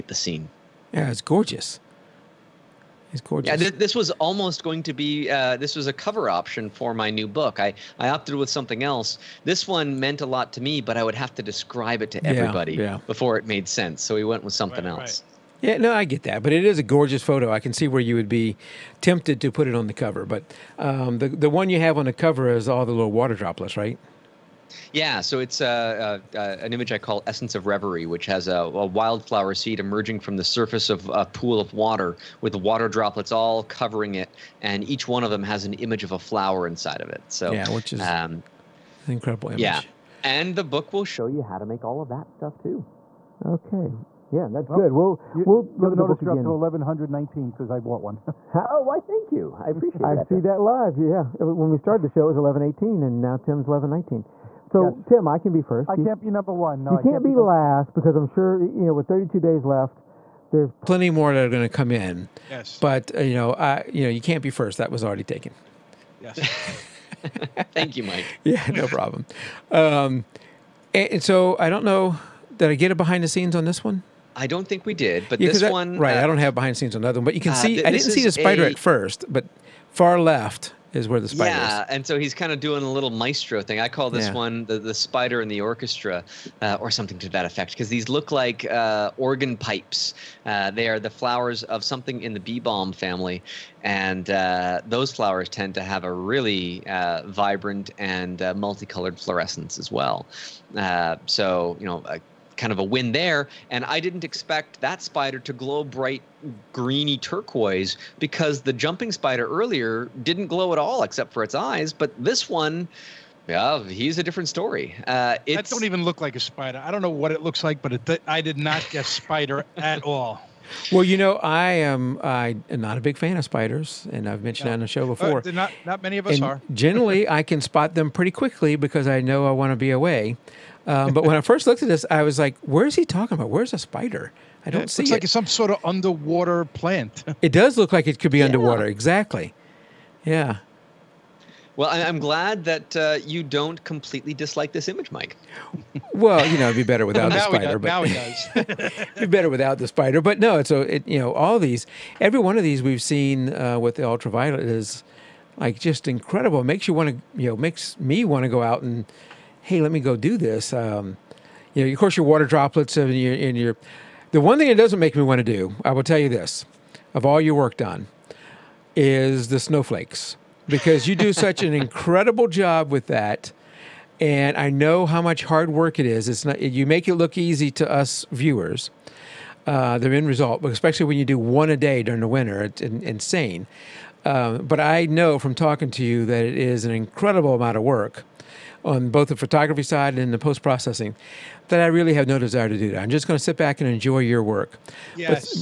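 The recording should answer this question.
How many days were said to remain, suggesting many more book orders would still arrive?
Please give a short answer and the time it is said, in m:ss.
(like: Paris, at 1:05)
32, at 0:59.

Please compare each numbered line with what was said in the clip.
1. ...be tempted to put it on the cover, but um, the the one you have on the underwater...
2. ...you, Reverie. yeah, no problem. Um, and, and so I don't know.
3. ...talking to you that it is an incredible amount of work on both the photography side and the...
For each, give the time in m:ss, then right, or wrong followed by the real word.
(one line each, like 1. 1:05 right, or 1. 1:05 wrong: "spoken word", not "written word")
1. 0:18 wrong: "cover", not "underwater"
2. 1:07 wrong: "Mike", not "Reverie"
3. 3:05 right.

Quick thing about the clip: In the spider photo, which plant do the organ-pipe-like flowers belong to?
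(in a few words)
bee balm.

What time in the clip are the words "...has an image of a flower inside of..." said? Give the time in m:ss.
0:35.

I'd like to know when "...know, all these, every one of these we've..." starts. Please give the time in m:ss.
2:31.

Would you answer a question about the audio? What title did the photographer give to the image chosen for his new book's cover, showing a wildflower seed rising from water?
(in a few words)
Essence of Reverie.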